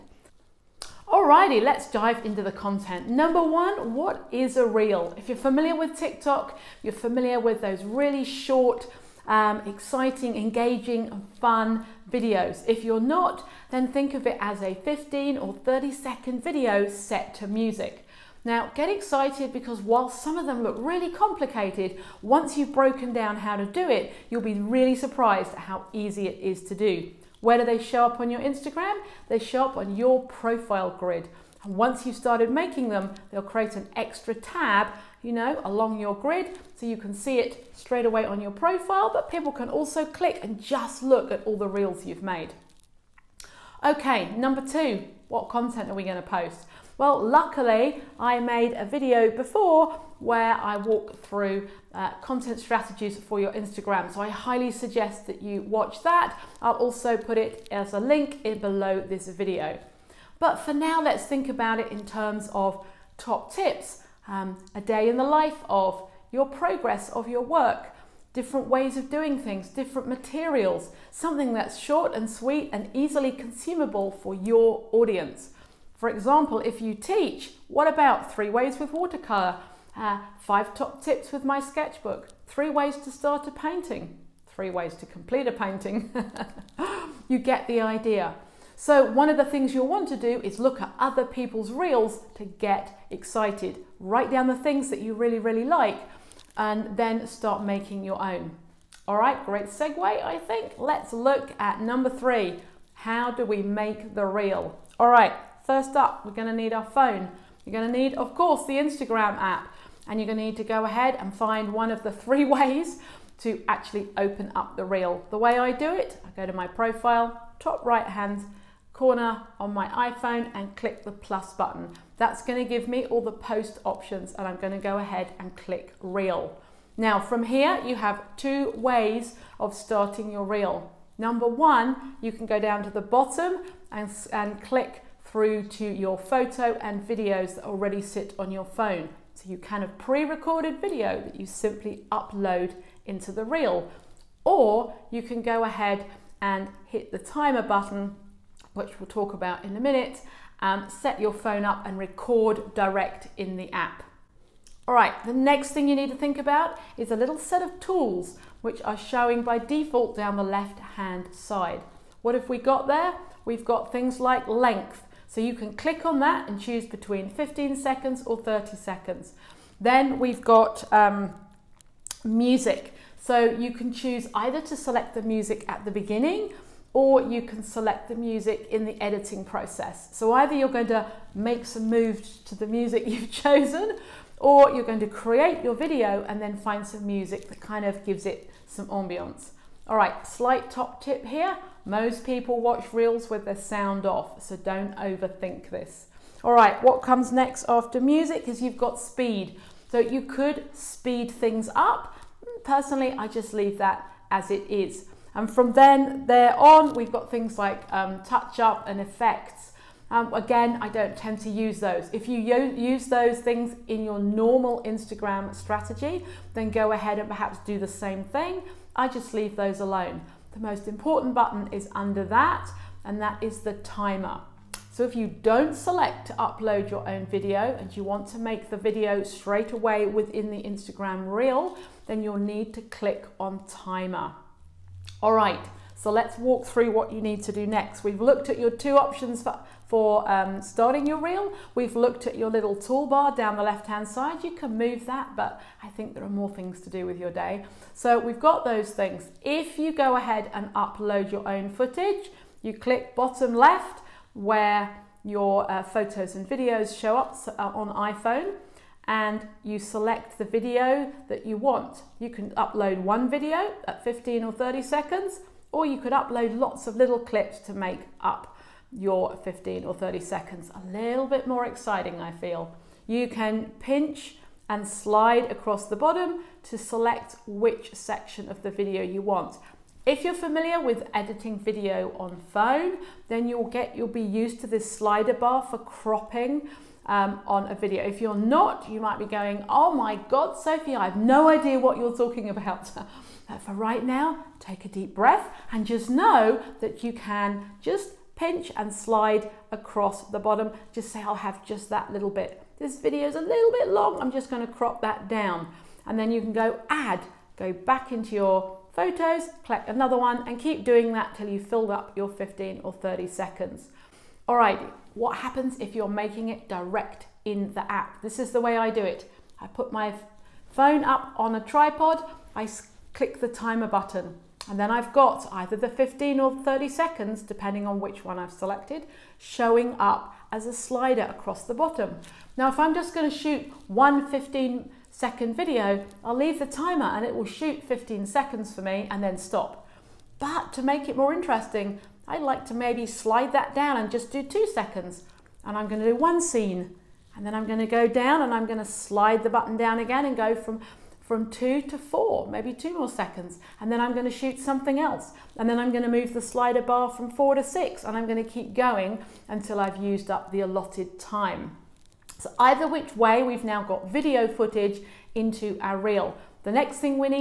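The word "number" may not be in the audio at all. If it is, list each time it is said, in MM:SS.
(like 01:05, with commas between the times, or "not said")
00:03, 00:44, 01:41, 02:11.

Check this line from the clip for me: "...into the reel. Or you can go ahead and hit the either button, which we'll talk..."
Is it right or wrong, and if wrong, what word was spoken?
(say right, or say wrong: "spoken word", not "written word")
wrong: "timer", not "either".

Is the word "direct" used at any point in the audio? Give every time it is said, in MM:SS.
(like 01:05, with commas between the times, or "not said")
02:32, 05:16.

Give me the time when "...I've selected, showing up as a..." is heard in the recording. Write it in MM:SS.
05:28.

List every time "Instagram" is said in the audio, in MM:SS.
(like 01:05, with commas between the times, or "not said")
00:28, 00:53, 01:48, 03:34, 03:50.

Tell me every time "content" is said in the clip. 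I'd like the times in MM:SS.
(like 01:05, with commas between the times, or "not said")
00:02, 00:45, 00:52.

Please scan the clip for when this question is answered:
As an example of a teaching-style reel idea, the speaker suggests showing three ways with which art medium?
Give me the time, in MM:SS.
01:18.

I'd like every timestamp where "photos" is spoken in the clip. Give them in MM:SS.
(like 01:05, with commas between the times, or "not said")
02:16, 04:15, 05:08.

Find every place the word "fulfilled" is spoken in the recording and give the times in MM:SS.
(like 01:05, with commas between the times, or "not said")
not said.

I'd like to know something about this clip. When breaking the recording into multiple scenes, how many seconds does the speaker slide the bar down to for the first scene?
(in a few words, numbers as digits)
2 seconds.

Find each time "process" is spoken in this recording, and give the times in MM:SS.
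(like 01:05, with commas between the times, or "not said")
02:59.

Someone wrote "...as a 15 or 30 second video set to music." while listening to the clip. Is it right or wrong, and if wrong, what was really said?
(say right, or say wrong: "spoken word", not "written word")
right.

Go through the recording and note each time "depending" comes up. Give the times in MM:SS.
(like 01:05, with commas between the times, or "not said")
05:27.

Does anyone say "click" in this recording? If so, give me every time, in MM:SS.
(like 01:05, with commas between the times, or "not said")
00:40, 02:00, 02:05, 02:14, 02:45, 03:52, 04:12, 05:23.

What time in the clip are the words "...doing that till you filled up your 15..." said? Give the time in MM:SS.
05:10.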